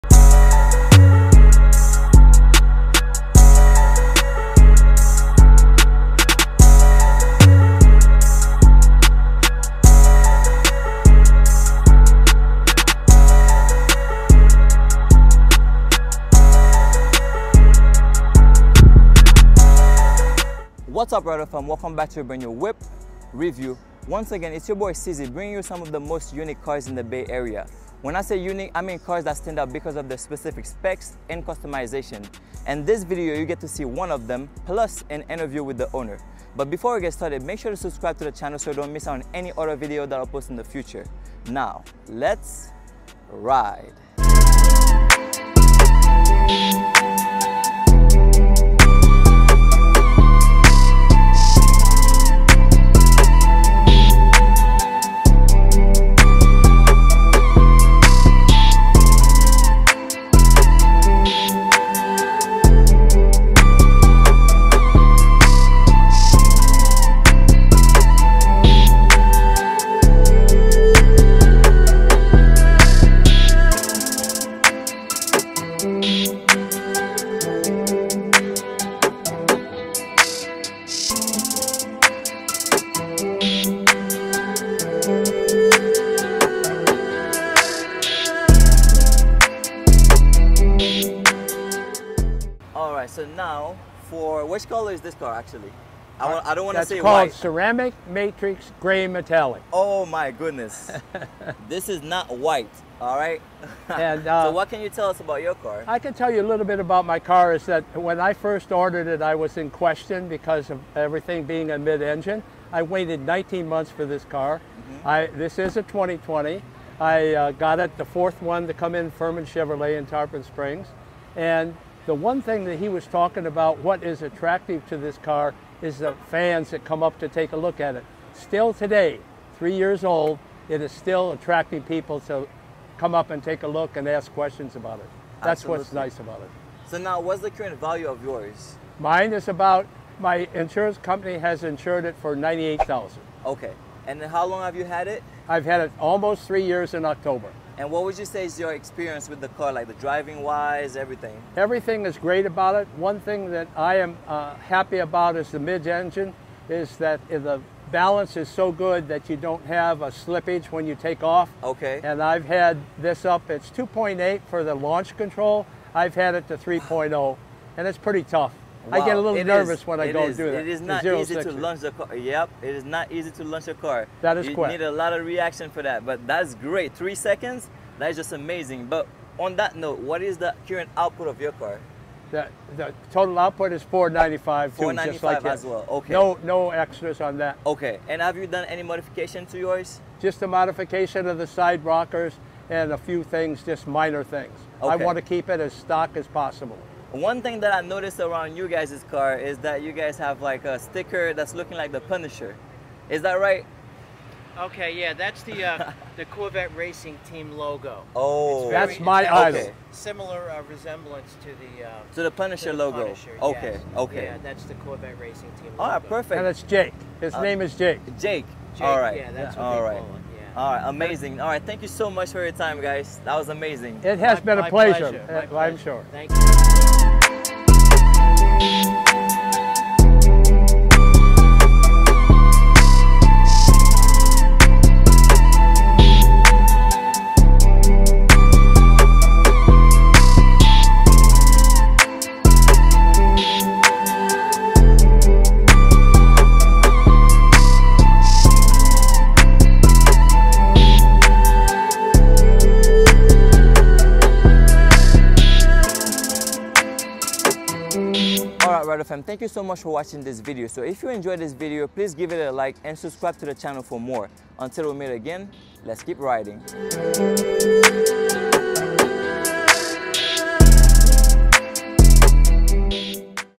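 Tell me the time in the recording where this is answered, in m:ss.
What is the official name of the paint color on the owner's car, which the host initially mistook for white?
1:37.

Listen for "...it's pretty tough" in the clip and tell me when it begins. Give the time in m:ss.
2:47.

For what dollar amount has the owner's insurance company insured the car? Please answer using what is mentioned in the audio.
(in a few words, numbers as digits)
$98,000.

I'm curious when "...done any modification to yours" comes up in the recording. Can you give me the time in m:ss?
3:08.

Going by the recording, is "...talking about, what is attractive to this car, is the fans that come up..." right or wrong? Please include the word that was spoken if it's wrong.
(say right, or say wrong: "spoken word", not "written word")
right.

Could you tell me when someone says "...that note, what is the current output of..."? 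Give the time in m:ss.
2:59.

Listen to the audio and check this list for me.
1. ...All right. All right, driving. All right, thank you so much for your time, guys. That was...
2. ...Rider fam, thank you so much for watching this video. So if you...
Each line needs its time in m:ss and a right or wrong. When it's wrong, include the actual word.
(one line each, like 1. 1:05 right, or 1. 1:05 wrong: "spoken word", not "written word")
1. 3:39 wrong: "amazing", not "driving"
2. 4:18 right.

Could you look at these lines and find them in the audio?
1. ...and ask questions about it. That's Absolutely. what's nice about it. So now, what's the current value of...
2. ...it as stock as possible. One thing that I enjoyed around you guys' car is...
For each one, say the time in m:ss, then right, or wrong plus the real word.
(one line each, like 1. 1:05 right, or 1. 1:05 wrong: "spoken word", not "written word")
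1. 2:13 right
2. 3:15 wrong: "noticed", not "enjoyed".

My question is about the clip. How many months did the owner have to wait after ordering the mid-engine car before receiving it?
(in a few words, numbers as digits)
19 months.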